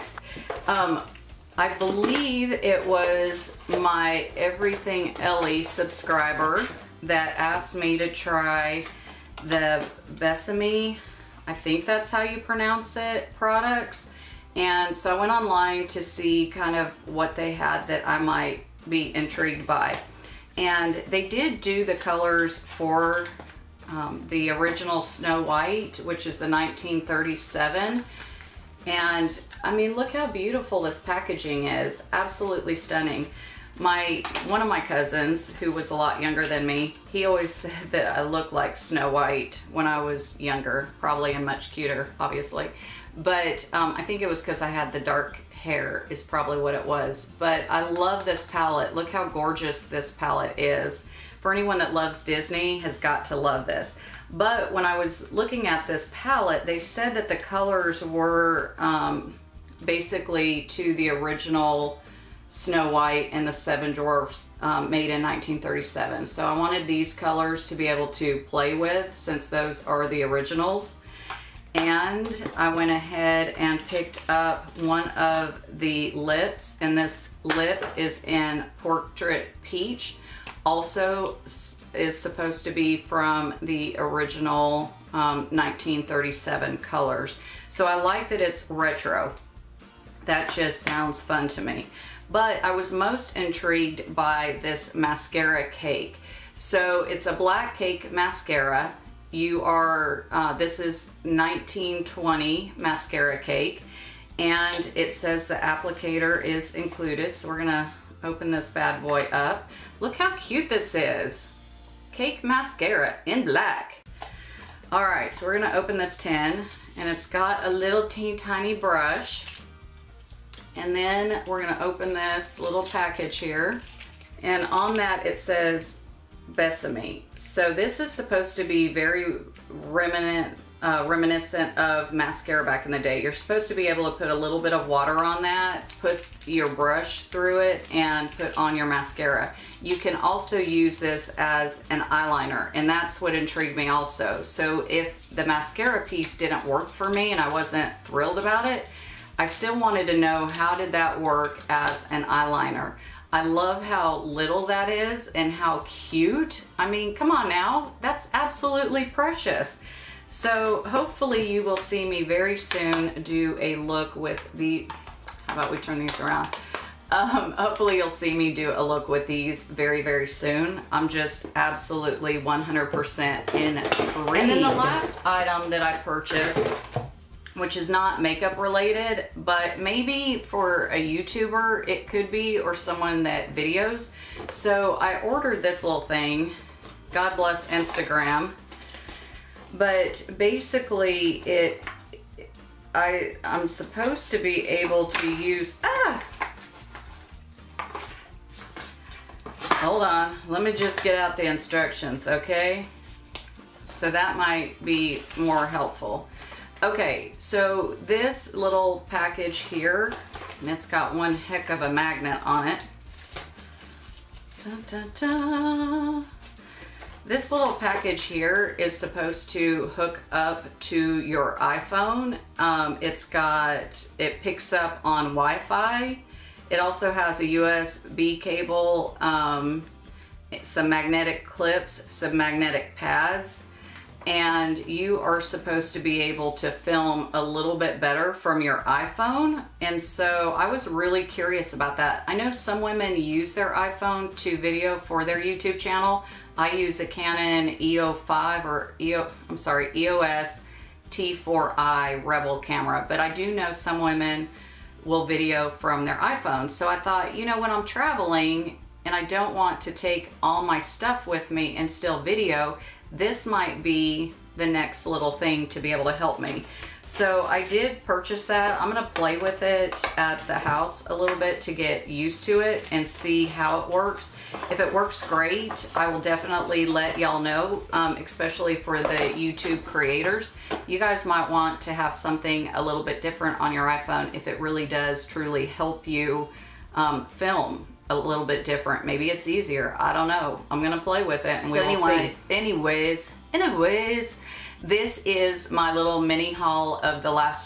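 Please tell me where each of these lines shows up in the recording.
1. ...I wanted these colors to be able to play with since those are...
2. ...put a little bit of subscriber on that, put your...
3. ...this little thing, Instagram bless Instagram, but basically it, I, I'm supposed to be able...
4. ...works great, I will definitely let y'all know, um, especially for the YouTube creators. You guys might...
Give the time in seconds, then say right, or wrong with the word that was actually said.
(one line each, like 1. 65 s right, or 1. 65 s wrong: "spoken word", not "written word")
1. 66 s right
2. 134 s wrong: "water", not "subscriber"
3. 185 s wrong: "God", not "Instagram"
4. 274 s right.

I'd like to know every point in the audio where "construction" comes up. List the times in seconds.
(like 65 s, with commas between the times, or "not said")
not said.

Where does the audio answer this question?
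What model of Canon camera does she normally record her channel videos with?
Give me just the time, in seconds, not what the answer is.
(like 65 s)
249 s.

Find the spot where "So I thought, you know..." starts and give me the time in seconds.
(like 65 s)
256 s.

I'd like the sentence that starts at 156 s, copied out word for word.
I mean, come on now, that's absolutely precious.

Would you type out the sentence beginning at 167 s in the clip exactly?
Um, hopefully you'll see me do a look with these very, very soon.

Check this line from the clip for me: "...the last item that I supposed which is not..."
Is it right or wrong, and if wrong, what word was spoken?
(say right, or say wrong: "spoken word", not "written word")
wrong: "purchased", not "supposed".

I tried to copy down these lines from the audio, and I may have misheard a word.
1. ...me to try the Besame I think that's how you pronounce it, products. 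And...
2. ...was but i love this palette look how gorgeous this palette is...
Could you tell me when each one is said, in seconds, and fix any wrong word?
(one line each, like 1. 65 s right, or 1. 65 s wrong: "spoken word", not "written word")
1. 7 s right
2. 46 s right.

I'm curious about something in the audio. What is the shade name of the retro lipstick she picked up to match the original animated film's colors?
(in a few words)
Portrait Peach.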